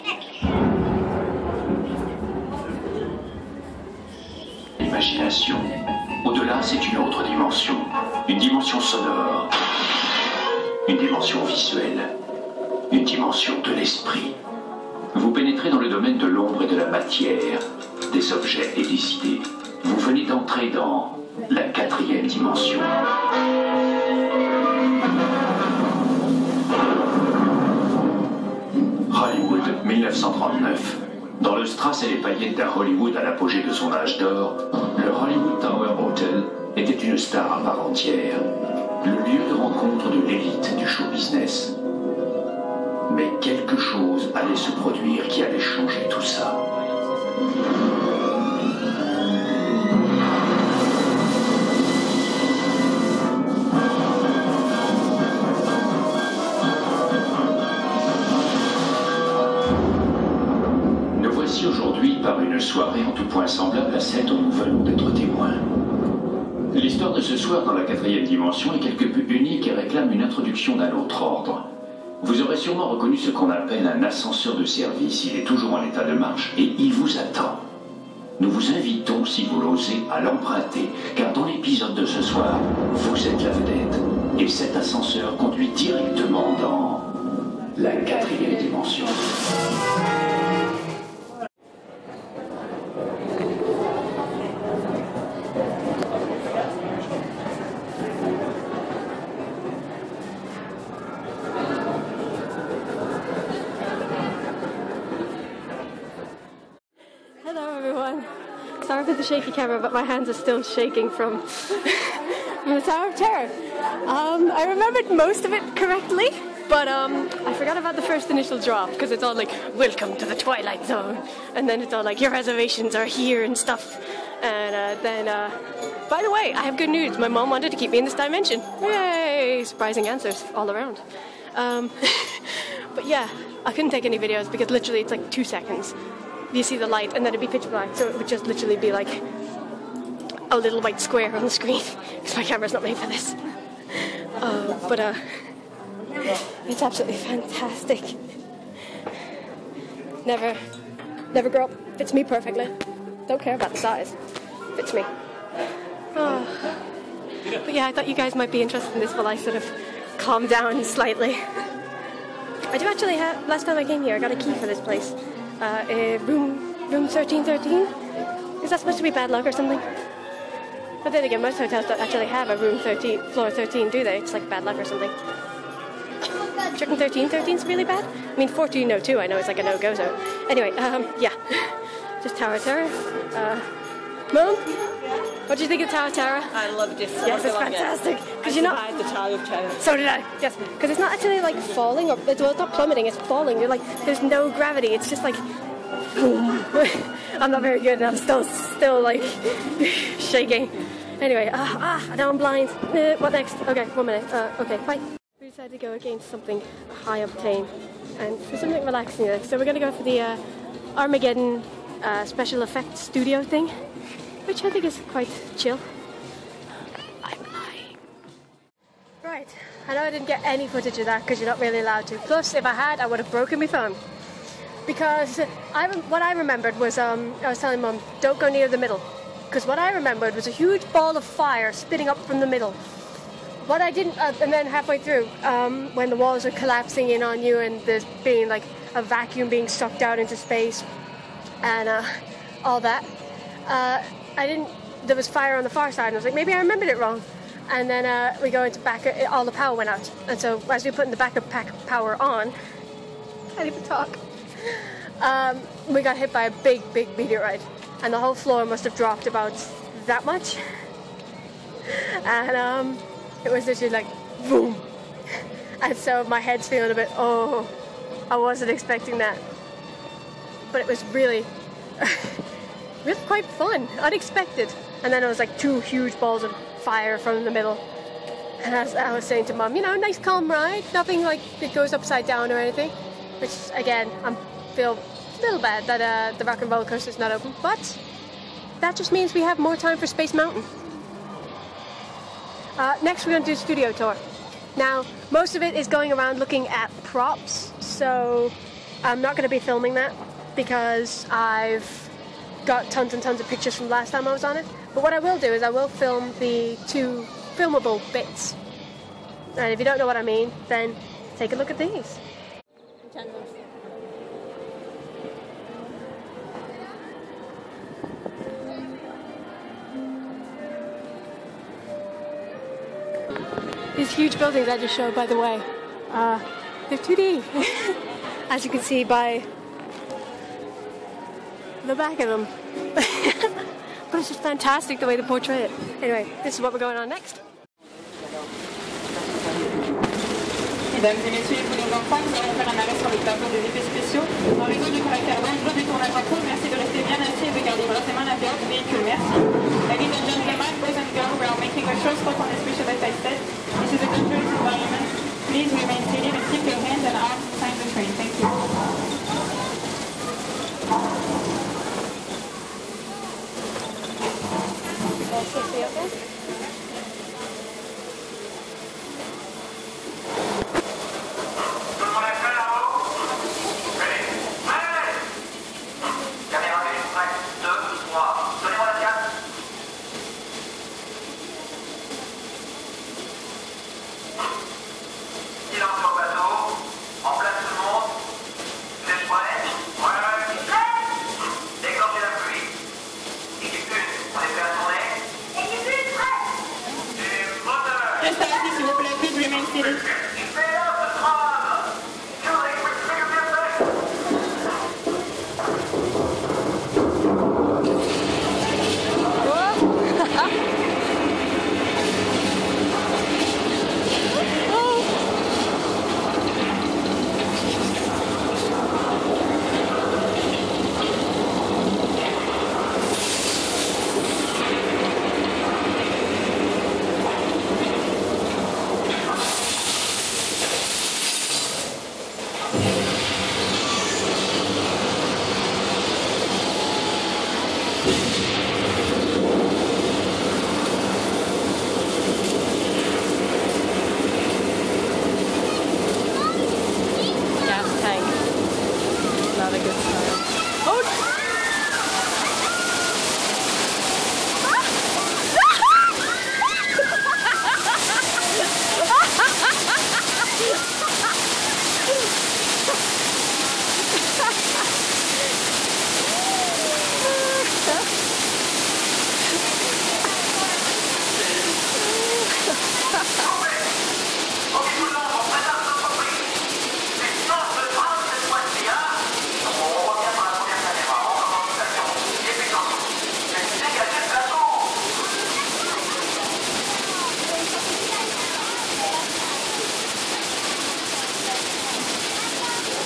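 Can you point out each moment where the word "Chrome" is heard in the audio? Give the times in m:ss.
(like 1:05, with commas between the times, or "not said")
not said.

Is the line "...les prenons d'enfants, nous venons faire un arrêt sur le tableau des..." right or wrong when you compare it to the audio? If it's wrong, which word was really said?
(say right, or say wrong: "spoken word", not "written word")
wrong: "allons", not "venons".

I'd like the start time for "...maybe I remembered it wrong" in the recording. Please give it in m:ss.
4:06.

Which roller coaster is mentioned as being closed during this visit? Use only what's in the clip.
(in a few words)
rock and roller coaster.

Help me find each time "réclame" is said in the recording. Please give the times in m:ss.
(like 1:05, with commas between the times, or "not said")
1:09.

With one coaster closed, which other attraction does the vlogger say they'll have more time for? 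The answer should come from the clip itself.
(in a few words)
Space Mountain.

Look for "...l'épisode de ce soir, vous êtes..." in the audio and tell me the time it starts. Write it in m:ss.
1:21.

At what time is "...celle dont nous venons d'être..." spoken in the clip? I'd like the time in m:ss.
1:03.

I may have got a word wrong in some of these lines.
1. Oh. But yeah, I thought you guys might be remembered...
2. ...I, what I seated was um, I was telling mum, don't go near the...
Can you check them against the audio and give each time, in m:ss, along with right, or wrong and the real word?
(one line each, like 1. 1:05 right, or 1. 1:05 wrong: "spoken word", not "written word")
1. 2:36 wrong: "interested", not "remembered"
2. 3:45 wrong: "remembered", not "seated".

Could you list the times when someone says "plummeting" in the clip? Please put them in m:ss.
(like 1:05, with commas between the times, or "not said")
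3:12.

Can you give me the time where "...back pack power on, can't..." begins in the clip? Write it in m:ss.
4:11.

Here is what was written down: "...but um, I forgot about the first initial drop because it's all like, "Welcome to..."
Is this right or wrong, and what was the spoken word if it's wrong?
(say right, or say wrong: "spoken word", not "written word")
right.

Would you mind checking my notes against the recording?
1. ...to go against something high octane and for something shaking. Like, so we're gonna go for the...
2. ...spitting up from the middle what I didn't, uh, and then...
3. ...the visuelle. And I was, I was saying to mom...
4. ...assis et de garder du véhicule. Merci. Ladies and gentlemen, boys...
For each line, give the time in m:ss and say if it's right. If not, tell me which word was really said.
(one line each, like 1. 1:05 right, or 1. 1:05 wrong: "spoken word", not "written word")
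1. 3:25 wrong: "relaxing", not "shaking"
2. 3:51 right
3. 4:37 wrong: "middle", not "visuelle"
4. 5:47 right.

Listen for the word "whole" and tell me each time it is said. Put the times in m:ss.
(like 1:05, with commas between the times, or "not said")
4:18.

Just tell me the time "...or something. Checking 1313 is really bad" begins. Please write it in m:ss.
2:54.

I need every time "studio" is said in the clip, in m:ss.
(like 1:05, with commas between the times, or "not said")
3:33, 4:53.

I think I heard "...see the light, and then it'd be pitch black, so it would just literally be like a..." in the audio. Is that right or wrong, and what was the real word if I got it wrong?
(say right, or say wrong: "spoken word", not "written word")
right.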